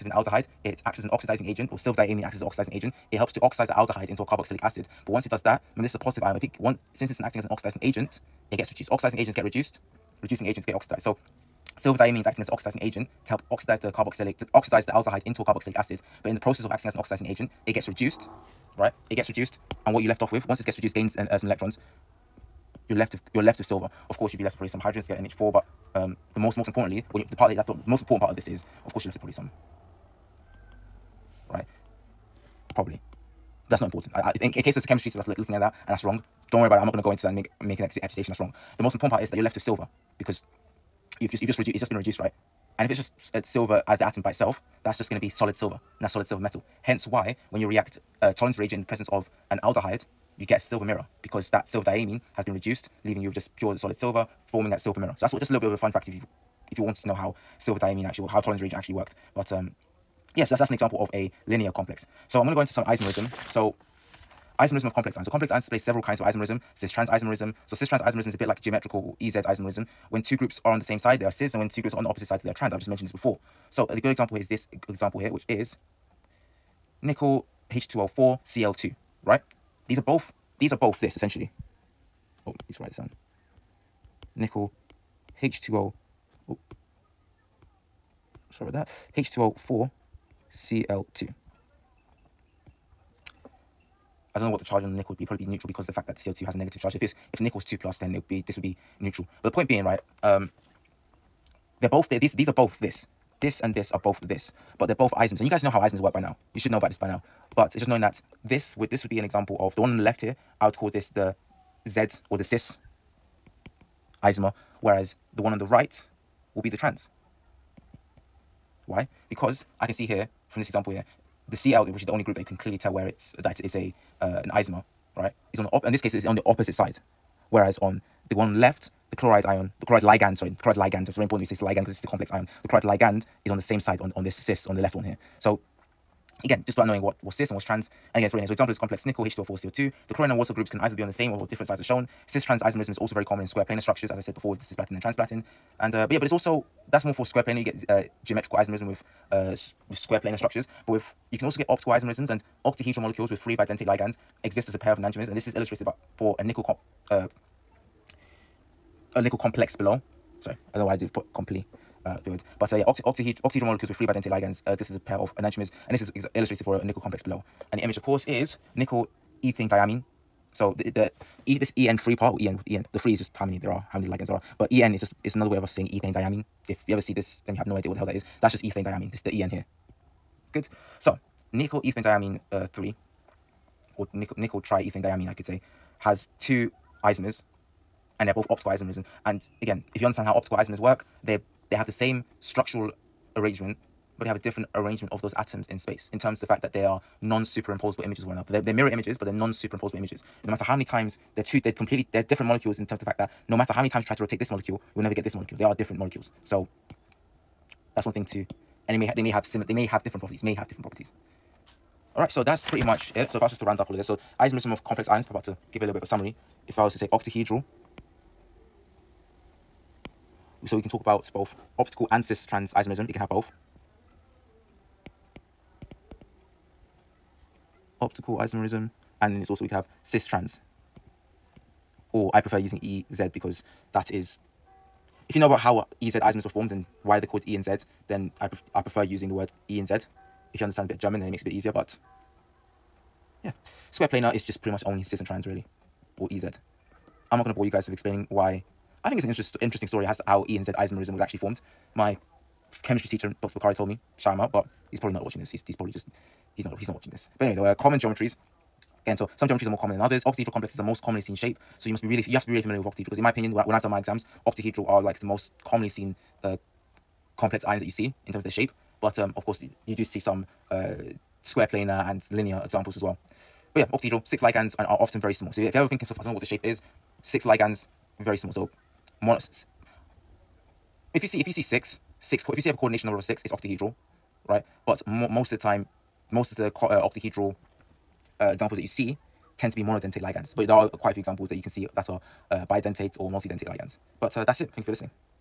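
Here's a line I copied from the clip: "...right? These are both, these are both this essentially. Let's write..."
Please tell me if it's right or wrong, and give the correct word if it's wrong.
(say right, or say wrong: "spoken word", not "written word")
right.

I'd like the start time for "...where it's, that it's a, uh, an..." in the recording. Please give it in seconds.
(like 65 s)
122 s.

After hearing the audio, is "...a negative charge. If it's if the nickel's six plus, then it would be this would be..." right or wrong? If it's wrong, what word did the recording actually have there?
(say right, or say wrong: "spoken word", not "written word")
wrong: "two", not "six".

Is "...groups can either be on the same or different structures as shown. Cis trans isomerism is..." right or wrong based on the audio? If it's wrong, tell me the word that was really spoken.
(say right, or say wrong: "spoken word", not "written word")
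wrong: "sides", not "structures".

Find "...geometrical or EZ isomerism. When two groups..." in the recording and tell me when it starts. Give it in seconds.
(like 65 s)
68 s.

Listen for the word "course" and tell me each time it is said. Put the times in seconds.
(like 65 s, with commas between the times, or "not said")
24 s, 28 s, 168 s, 269 s.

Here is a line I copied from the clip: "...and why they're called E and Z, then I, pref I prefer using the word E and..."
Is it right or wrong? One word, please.
right.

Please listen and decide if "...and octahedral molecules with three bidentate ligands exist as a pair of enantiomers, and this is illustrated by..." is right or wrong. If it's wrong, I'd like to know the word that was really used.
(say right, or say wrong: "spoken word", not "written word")
right.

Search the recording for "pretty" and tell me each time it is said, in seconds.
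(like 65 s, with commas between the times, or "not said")
212 s, 244 s.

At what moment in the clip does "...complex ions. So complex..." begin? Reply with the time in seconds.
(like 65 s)
64 s.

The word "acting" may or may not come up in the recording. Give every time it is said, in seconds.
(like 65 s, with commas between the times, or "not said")
7 s, 12 s, 16 s.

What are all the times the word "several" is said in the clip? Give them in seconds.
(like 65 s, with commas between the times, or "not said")
65 s.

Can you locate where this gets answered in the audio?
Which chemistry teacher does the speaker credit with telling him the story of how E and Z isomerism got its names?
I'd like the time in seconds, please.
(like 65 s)
253 s.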